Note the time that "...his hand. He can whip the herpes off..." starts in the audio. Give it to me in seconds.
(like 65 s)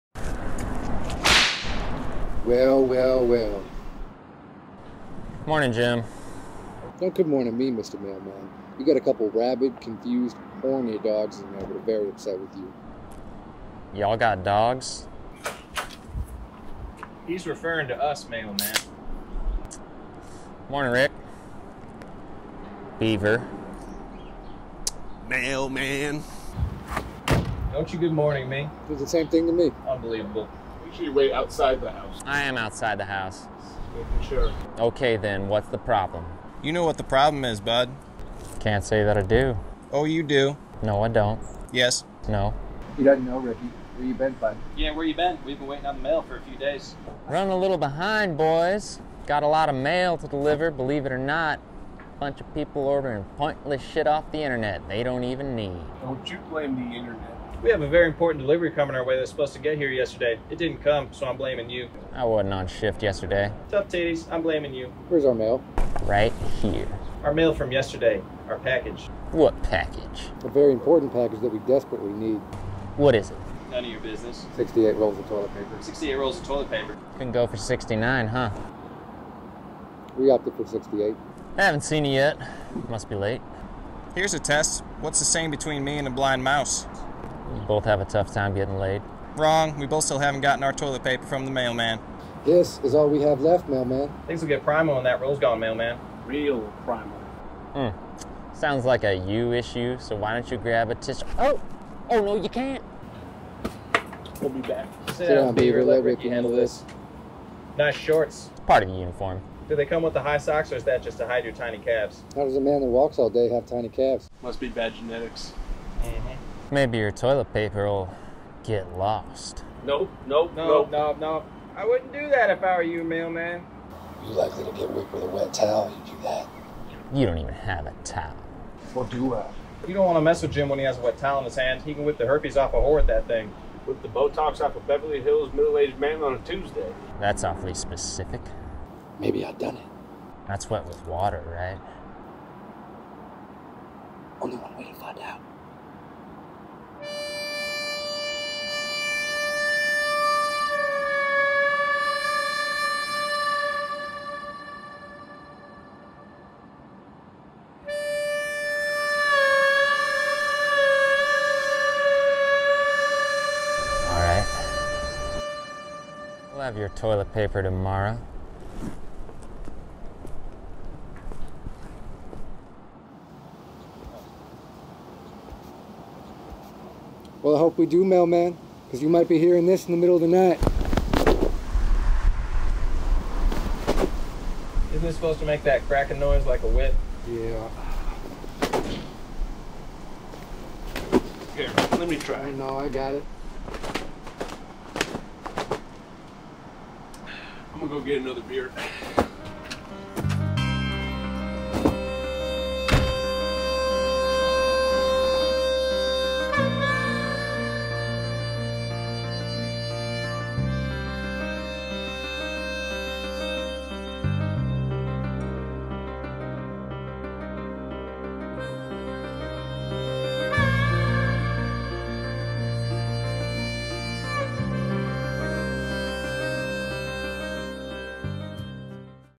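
131 s.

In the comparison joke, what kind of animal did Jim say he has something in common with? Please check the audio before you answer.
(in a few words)
A blind mouse.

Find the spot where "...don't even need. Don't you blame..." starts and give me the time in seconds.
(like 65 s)
55 s.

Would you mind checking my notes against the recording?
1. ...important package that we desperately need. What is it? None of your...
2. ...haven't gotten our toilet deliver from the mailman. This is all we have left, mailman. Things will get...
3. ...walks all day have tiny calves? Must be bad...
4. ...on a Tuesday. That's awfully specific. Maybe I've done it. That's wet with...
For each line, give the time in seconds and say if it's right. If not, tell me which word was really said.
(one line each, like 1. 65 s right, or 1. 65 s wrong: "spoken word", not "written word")
1. 70 s right
2. 90 s wrong: "paper", not "deliver"
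3. 112 s right
4. 136 s right.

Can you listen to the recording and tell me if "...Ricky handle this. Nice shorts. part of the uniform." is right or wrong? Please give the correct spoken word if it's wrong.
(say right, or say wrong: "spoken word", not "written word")
right.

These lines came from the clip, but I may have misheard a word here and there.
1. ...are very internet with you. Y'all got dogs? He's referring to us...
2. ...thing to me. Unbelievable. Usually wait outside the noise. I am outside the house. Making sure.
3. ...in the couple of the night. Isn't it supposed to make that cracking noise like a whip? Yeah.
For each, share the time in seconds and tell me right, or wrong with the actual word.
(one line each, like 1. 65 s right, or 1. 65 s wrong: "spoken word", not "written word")
1. 11 s wrong: "upset", not "internet"
2. 29 s wrong: "house", not "noise"
3. 179 s wrong: "middle", not "couple".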